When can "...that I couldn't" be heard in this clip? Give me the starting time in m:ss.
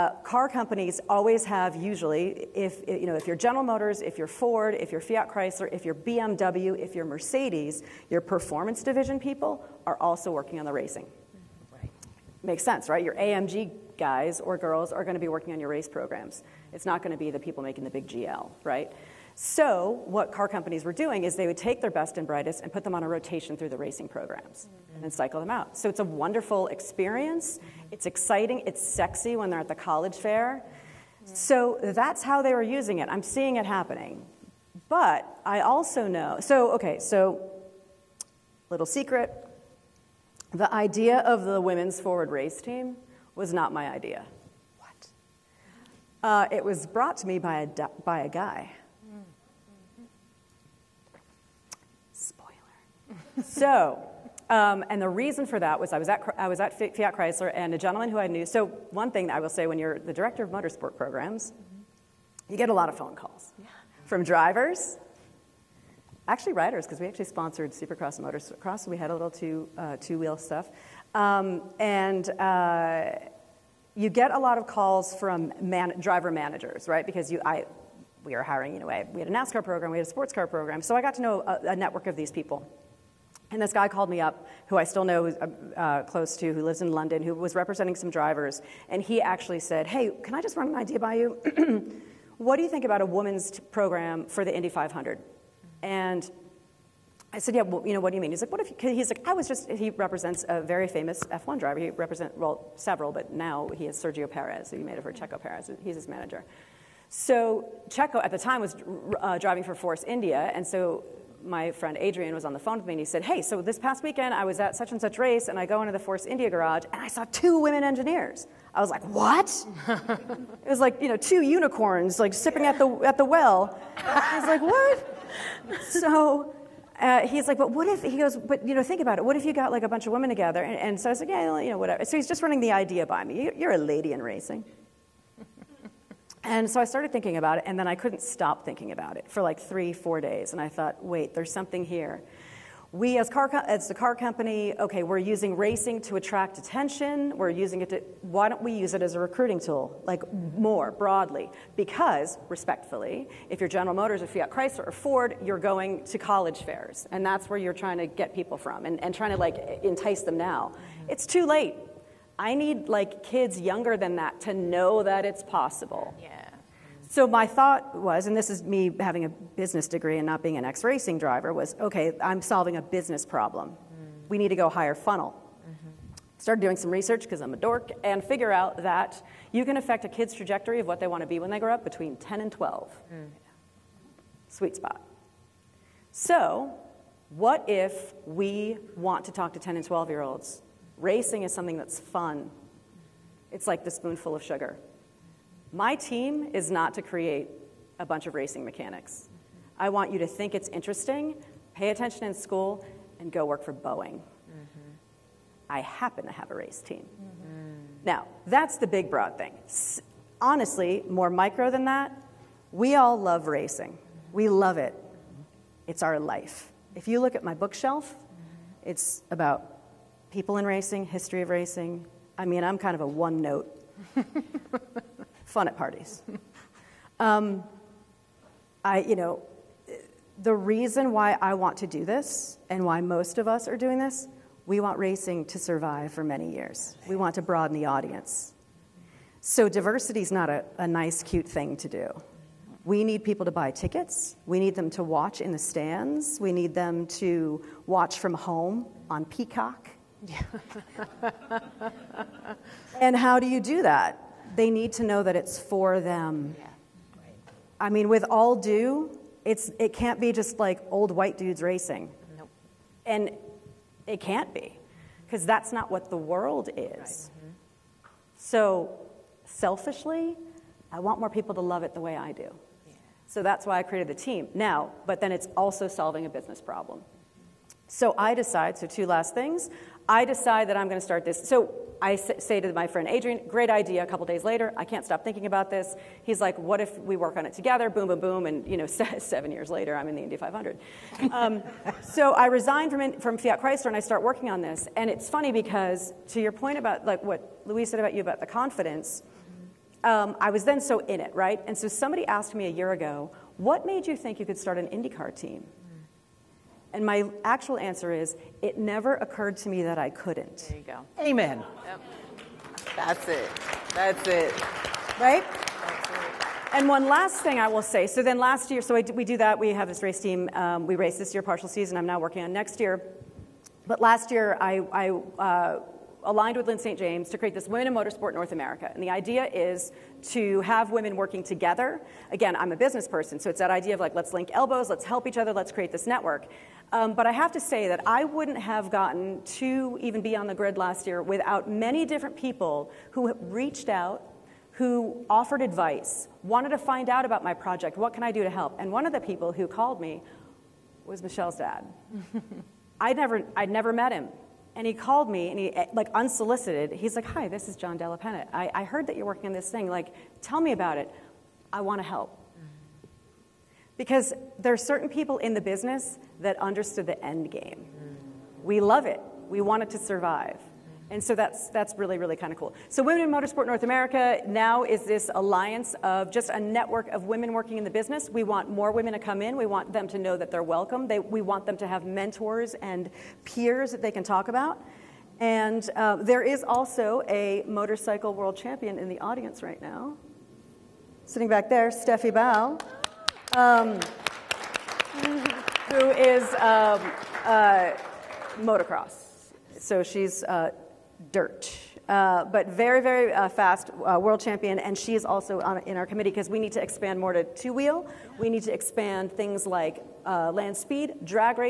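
5:09.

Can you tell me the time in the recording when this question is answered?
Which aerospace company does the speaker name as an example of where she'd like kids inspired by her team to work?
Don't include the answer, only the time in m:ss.
3:23.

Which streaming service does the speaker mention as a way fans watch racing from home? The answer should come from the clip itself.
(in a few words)
Peacock.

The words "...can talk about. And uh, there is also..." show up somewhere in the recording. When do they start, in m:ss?
6:24.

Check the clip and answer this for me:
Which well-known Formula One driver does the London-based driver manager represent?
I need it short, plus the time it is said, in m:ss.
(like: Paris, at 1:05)
Sergio Perez, at 1:44.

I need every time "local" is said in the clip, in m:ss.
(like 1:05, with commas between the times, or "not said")
not said.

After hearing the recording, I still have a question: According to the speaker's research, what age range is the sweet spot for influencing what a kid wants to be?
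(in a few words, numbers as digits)
10 and 12.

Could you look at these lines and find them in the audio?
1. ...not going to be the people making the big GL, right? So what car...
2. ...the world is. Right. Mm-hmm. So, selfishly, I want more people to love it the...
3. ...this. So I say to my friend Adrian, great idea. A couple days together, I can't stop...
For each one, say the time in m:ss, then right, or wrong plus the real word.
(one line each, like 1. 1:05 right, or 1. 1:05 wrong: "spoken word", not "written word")
1. 0:16 right
2. 4:26 right
3. 4:41 wrong: "later", not "together".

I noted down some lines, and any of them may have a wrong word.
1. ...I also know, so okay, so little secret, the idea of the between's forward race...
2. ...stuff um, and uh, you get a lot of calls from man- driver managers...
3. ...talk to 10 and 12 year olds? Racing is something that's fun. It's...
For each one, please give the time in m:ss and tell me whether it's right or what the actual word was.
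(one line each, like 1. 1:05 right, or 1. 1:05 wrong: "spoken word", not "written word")
1. 0:35 wrong: "women", not "between"
2. 1:10 right
3. 3:09 right.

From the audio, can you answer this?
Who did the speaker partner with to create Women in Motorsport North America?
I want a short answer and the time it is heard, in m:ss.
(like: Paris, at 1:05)
Lyn St. James, at 5:26.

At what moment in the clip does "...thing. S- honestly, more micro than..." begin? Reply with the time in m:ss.
3:29.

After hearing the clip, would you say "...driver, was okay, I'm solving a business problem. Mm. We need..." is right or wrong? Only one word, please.
right.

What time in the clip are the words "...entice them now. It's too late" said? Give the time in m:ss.
2:39.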